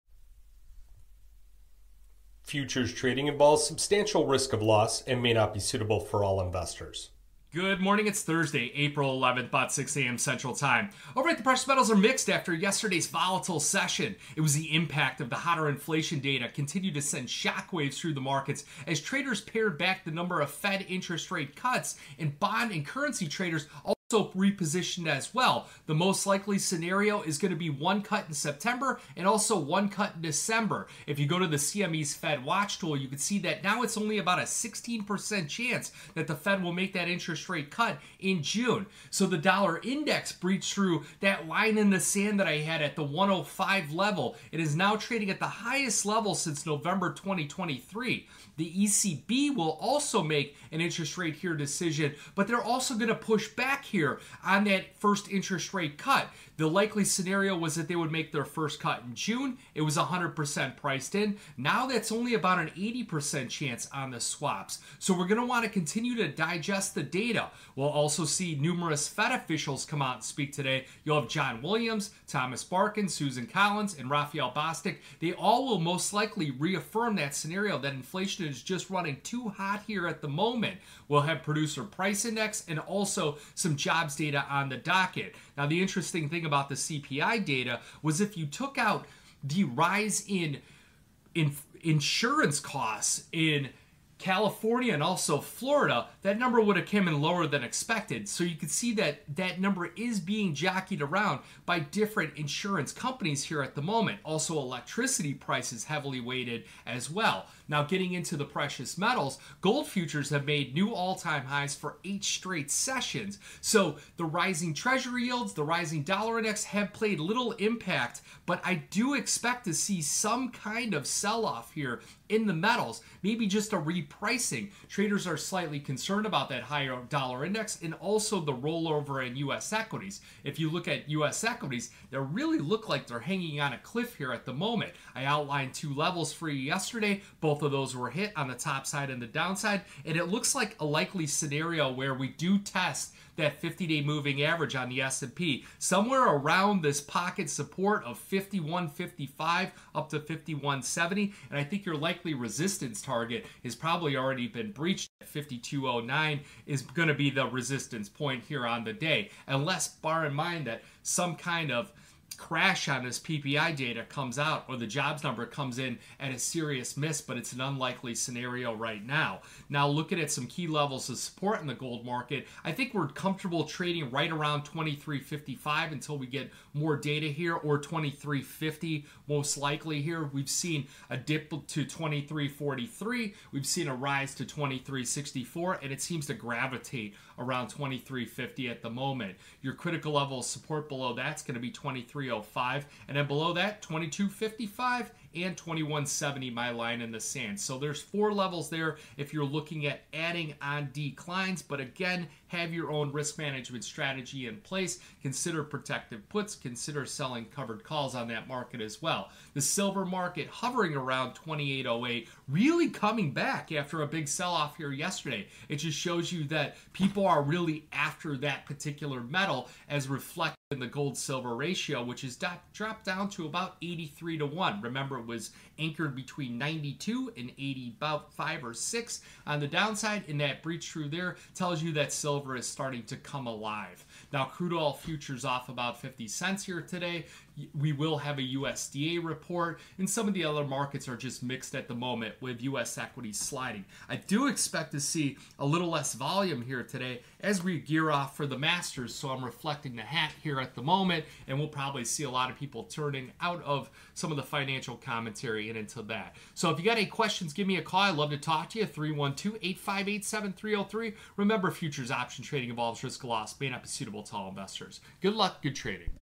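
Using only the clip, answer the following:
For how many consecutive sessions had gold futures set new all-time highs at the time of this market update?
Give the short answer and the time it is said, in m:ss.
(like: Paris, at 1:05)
8, at 1:52.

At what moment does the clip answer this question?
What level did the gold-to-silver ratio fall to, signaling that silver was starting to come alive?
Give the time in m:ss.
3:43.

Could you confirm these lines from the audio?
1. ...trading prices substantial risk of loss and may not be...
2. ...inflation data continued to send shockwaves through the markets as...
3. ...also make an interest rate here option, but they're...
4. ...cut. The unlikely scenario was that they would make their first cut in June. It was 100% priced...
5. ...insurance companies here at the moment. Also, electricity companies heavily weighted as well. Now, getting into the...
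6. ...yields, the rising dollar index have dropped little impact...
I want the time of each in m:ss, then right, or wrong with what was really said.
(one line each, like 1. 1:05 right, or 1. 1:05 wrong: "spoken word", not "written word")
1. 0:02 wrong: "involves", not "prices"
2. 0:15 right
3. 0:49 wrong: "decision", not "option"
4. 0:55 wrong: "likely", not "unlikely"
5. 1:42 wrong: "prices", not "companies"
6. 1:55 wrong: "played", not "dropped".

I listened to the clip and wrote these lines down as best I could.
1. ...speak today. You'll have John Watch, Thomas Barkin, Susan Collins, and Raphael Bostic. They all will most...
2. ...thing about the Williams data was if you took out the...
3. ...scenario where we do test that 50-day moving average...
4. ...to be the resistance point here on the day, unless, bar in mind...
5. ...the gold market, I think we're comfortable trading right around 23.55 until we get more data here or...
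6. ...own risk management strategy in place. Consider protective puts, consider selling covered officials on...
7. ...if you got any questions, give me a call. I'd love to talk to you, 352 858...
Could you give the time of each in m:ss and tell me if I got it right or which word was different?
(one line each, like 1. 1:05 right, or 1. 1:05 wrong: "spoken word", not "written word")
1. 1:10 wrong: "Williams", not "Watch"
2. 1:26 wrong: "CPI", not "Williams"
3. 2:21 right
4. 2:37 right
5. 2:51 right
6. 3:22 wrong: "calls", not "officials"
7. 4:16 wrong: "312", not "352".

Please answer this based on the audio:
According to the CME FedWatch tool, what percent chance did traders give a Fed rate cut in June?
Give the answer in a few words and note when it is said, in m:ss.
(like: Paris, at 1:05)
16%, at 0:34.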